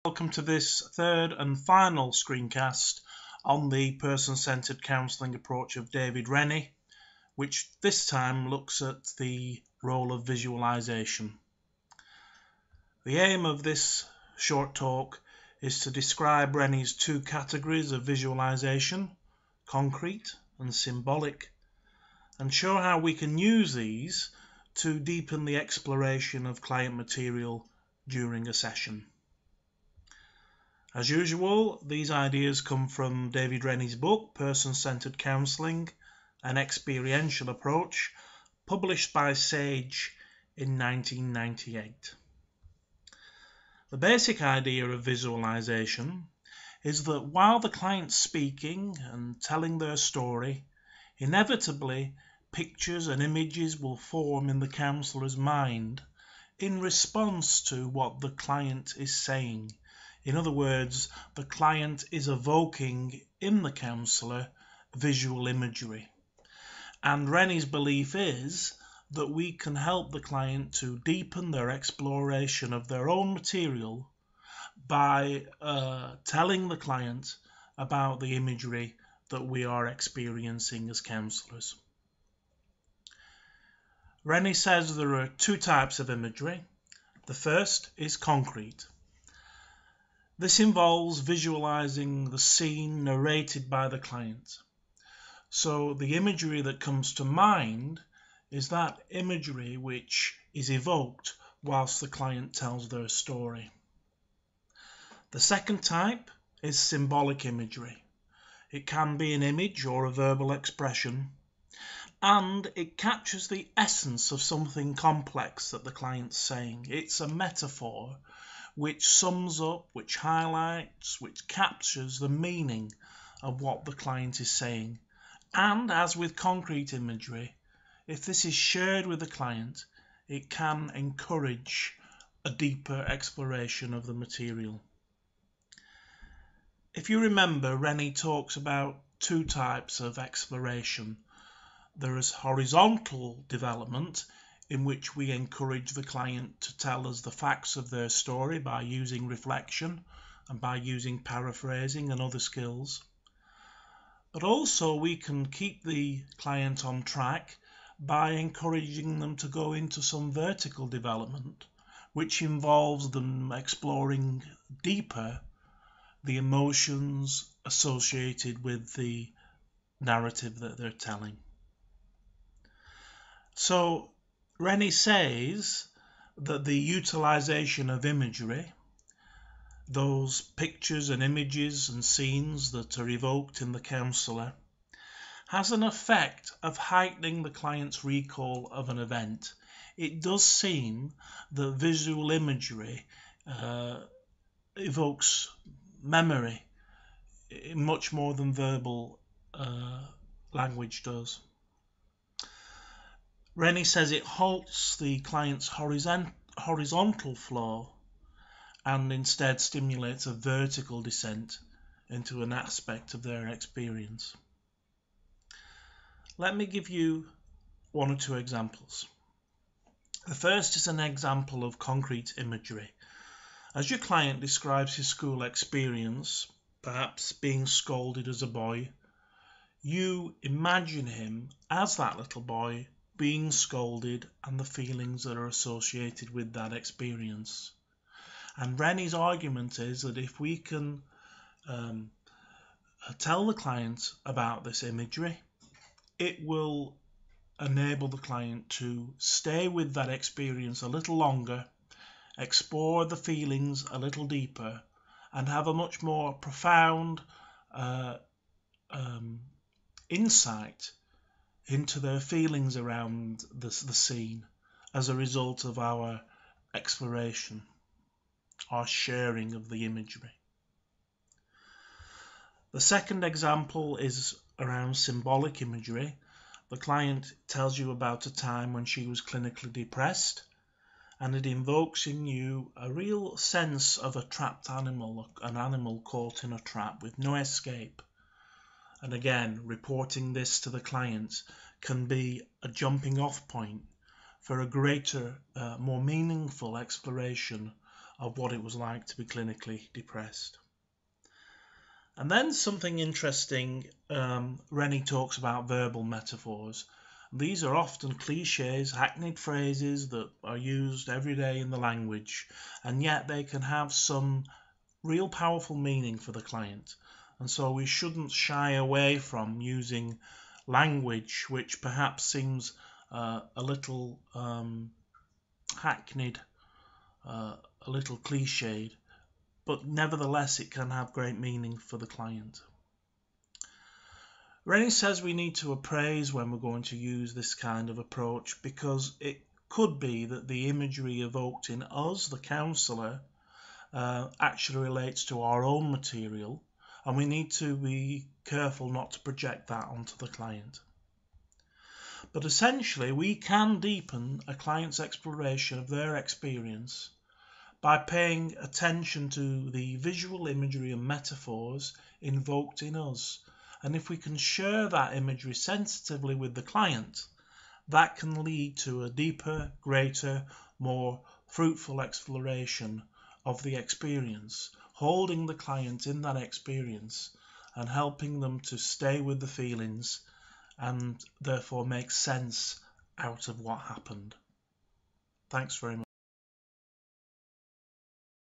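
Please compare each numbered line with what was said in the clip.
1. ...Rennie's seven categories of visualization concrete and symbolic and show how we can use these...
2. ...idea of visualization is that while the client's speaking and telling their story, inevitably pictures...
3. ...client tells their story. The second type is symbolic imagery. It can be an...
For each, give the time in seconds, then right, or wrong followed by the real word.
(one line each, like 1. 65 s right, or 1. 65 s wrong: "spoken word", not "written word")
1. 16 s wrong: "two", not "seven"
2. 44 s right
3. 102 s right.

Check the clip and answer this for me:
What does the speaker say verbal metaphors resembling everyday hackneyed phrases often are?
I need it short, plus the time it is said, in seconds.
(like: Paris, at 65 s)
Cliches, at 308 s.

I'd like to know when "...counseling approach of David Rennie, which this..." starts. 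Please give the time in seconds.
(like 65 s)
4 s.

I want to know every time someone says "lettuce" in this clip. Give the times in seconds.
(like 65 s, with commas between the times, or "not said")
not said.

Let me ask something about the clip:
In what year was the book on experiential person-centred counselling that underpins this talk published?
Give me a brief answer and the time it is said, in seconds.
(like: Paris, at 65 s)
1998, at 40 s.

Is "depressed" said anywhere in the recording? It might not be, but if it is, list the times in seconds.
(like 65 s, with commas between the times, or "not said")
279 s, 299 s.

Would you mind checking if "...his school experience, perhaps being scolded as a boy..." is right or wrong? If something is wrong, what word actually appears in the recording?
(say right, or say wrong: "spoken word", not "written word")
right.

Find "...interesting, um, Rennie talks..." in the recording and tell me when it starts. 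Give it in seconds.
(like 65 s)
302 s.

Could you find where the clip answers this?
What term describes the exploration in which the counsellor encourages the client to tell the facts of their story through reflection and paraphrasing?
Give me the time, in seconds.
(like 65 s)
142 s.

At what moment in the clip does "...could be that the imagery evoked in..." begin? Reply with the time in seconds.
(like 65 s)
339 s.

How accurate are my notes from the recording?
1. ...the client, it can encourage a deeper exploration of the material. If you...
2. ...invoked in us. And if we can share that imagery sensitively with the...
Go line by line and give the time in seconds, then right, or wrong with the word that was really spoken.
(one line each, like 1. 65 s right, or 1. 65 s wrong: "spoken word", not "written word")
1. 129 s right
2. 362 s right.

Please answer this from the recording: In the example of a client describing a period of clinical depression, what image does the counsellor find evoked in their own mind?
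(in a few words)
A trapped animal.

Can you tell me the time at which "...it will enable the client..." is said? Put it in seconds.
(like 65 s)
246 s.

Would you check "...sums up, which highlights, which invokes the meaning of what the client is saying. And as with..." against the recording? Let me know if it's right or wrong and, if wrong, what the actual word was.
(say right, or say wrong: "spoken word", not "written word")
wrong: "captures", not "invokes".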